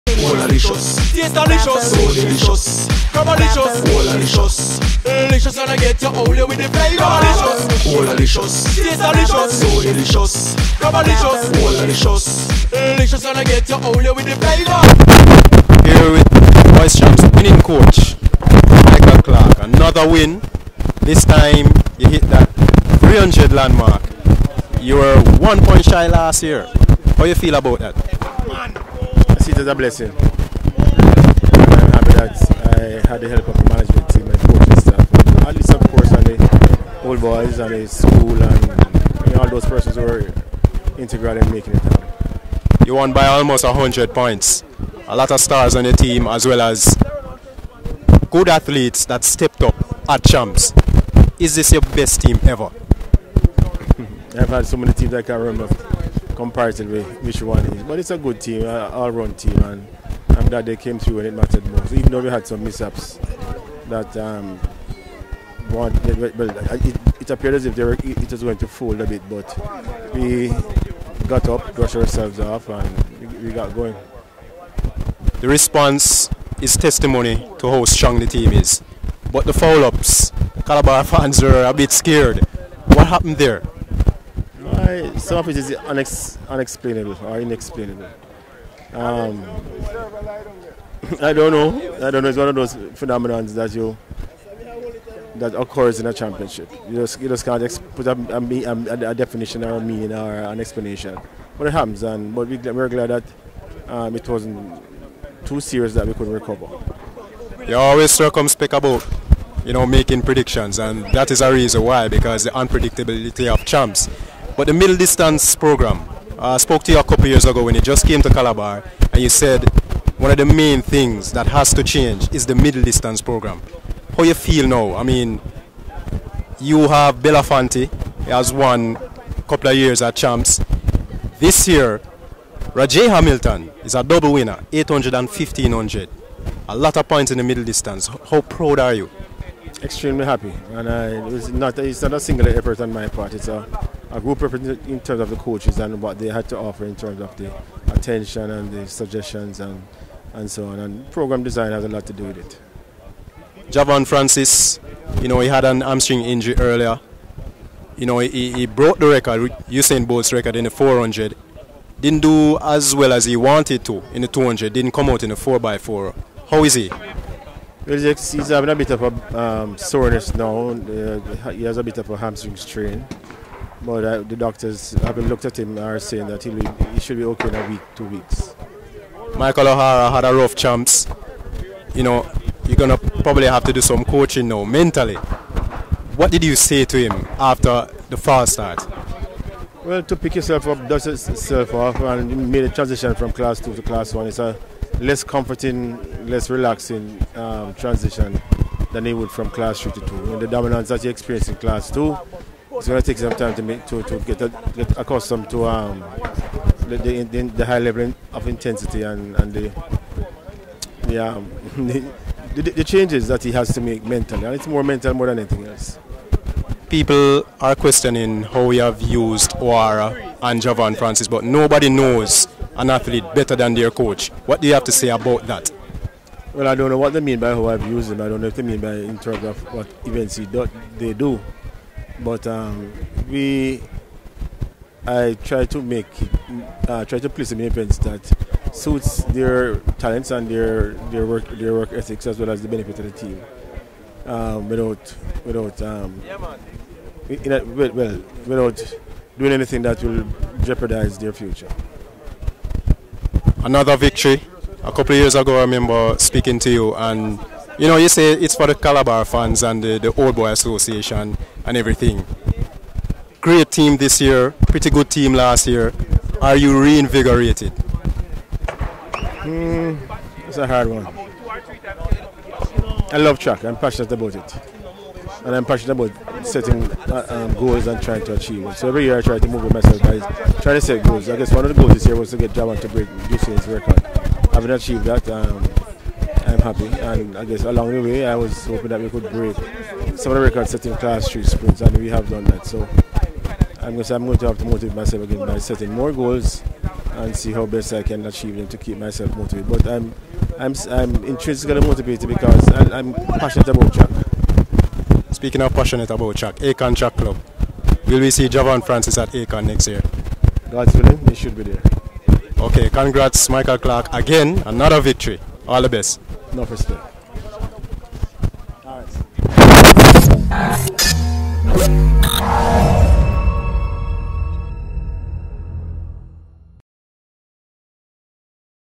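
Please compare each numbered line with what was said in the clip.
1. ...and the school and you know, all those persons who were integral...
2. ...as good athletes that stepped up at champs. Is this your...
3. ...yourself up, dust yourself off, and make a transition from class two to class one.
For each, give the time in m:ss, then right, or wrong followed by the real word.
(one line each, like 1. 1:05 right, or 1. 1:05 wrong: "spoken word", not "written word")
1. 0:37 right
2. 0:46 right
3. 3:10 right.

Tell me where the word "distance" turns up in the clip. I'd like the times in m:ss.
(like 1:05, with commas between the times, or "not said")
1:54, 2:02, 2:17.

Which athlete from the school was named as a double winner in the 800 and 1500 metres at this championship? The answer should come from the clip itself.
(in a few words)
Rajay Hamilton.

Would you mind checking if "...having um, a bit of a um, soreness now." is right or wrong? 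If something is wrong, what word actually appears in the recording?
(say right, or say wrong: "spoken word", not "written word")
right.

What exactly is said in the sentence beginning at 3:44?
What do you have to say about that?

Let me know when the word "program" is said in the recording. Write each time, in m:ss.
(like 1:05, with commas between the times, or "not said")
1:55, 2:03, 2:31.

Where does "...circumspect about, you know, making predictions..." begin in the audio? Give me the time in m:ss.
1:48.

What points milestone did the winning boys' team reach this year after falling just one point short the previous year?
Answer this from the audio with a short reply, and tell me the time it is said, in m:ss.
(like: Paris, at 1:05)
300, at 0:22.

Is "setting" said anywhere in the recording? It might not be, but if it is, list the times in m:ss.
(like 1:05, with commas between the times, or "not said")
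4:36, 4:50, 4:55.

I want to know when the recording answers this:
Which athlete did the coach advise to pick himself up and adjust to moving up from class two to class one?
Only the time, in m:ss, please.
2:59.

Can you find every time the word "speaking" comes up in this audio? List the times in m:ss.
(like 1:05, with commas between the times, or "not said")
4:16, 5:05.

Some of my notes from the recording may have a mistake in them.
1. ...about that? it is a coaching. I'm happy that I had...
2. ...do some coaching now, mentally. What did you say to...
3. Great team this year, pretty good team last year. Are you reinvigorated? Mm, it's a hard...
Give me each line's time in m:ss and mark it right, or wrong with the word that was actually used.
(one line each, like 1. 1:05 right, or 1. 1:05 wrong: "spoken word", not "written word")
1. 0:27 wrong: "blessing", not "coaching"
2. 3:03 right
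3. 4:23 right.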